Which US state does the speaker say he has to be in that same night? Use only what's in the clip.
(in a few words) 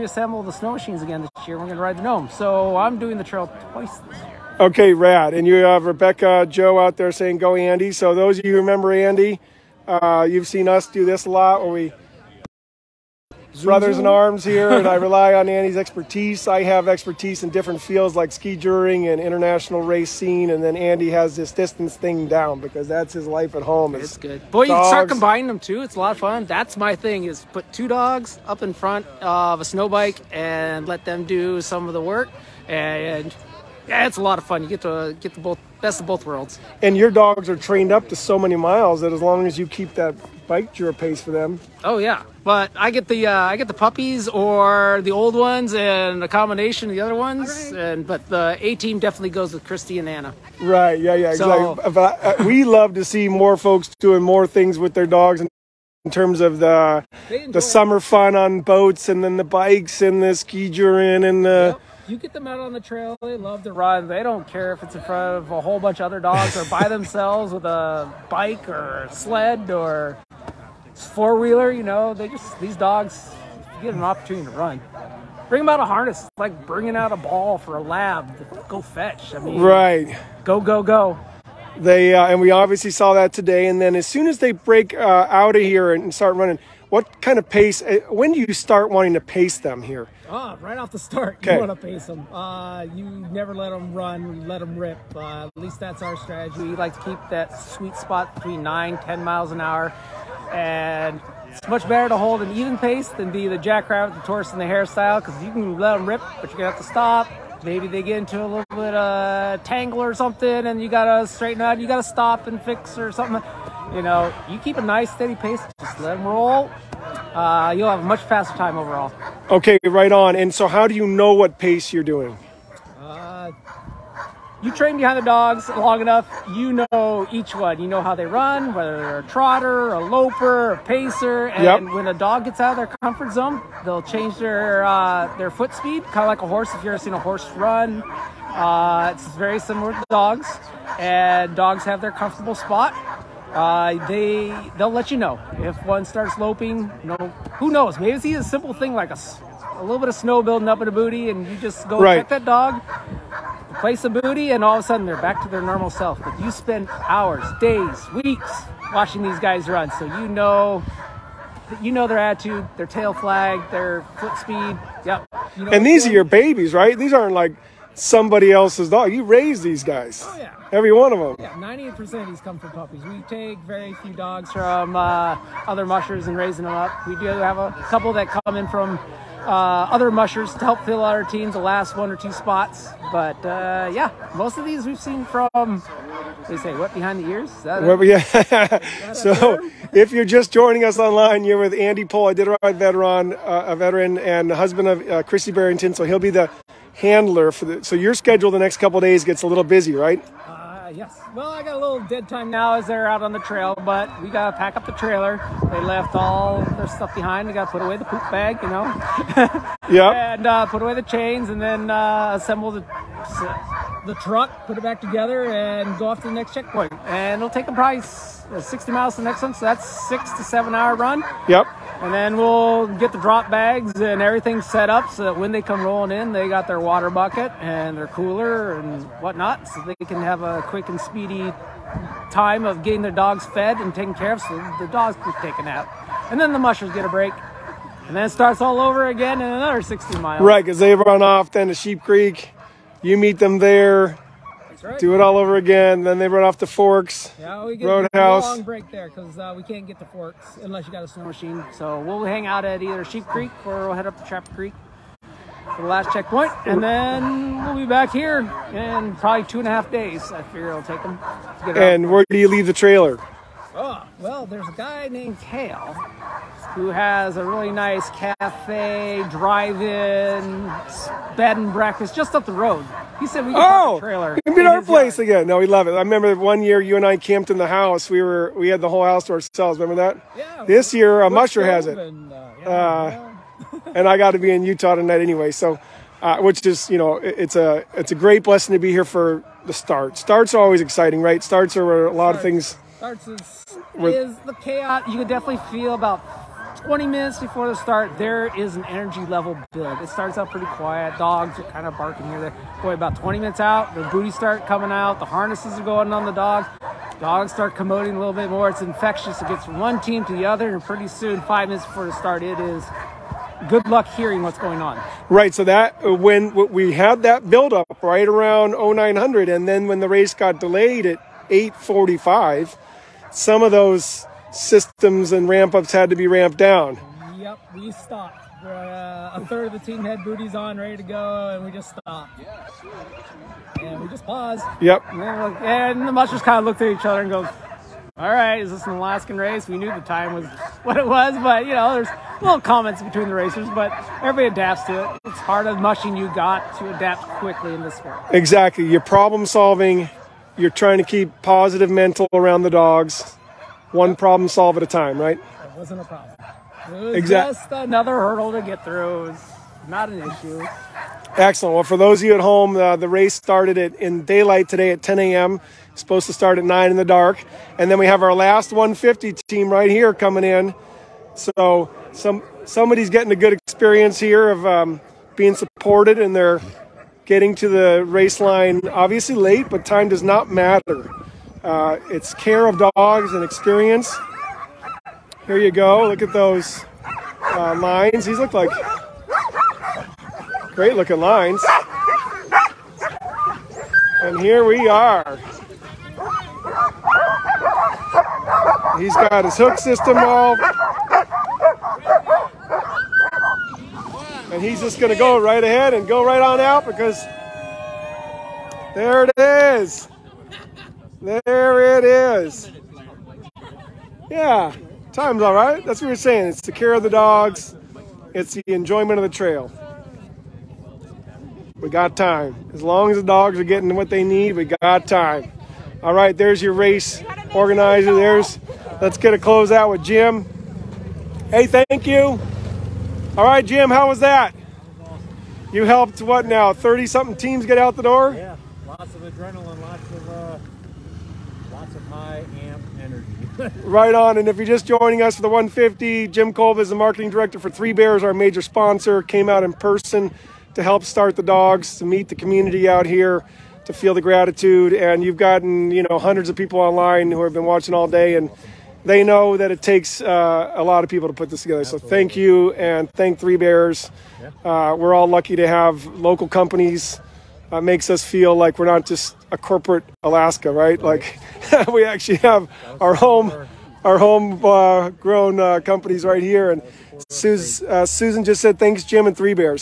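Utah.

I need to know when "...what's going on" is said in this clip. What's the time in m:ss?
5:14.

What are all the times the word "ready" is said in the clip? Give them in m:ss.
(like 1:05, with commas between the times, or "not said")
5:30.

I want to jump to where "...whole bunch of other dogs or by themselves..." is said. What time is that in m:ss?
1:05.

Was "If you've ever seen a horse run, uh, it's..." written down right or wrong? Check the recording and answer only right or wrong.
right.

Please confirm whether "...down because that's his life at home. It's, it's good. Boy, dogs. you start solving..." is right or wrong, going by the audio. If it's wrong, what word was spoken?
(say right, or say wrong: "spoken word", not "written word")
wrong: "combining", not "solving".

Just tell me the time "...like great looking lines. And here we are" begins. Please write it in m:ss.
6:28.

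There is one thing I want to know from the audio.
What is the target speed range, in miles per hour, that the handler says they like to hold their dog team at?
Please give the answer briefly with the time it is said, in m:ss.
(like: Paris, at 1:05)
9 to 10, at 1:38.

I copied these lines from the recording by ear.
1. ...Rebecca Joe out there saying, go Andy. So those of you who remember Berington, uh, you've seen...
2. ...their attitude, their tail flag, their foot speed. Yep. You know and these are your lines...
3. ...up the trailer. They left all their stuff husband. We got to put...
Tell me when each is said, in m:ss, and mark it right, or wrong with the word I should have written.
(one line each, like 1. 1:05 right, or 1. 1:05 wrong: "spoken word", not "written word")
1. 0:05 wrong: "Andy", not "Berington"
2. 2:42 wrong: "babies", not "lines"
3. 3:24 wrong: "behind", not "husband".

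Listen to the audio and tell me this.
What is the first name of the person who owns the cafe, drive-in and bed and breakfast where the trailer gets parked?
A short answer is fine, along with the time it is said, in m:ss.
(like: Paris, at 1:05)
Kale, at 4:25.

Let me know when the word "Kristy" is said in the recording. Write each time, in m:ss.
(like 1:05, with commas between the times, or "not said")
0:49, 3:15.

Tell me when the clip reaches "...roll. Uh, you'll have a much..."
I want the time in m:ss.
1:56.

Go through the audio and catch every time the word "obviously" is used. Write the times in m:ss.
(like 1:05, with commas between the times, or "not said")
1:22, 6:18.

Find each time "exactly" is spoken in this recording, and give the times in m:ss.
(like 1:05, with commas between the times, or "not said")
0:51, 5:48, 5:57.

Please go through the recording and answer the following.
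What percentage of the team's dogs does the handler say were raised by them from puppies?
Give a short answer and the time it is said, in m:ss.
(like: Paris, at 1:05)
98%, at 2:51.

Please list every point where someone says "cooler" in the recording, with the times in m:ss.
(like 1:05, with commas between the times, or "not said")
3:48.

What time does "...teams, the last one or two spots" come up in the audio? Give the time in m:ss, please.
3:01.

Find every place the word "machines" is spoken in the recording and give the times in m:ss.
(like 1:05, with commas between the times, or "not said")
0:00, 4:11.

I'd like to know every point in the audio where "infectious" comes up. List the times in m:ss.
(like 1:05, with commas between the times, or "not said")
5:08.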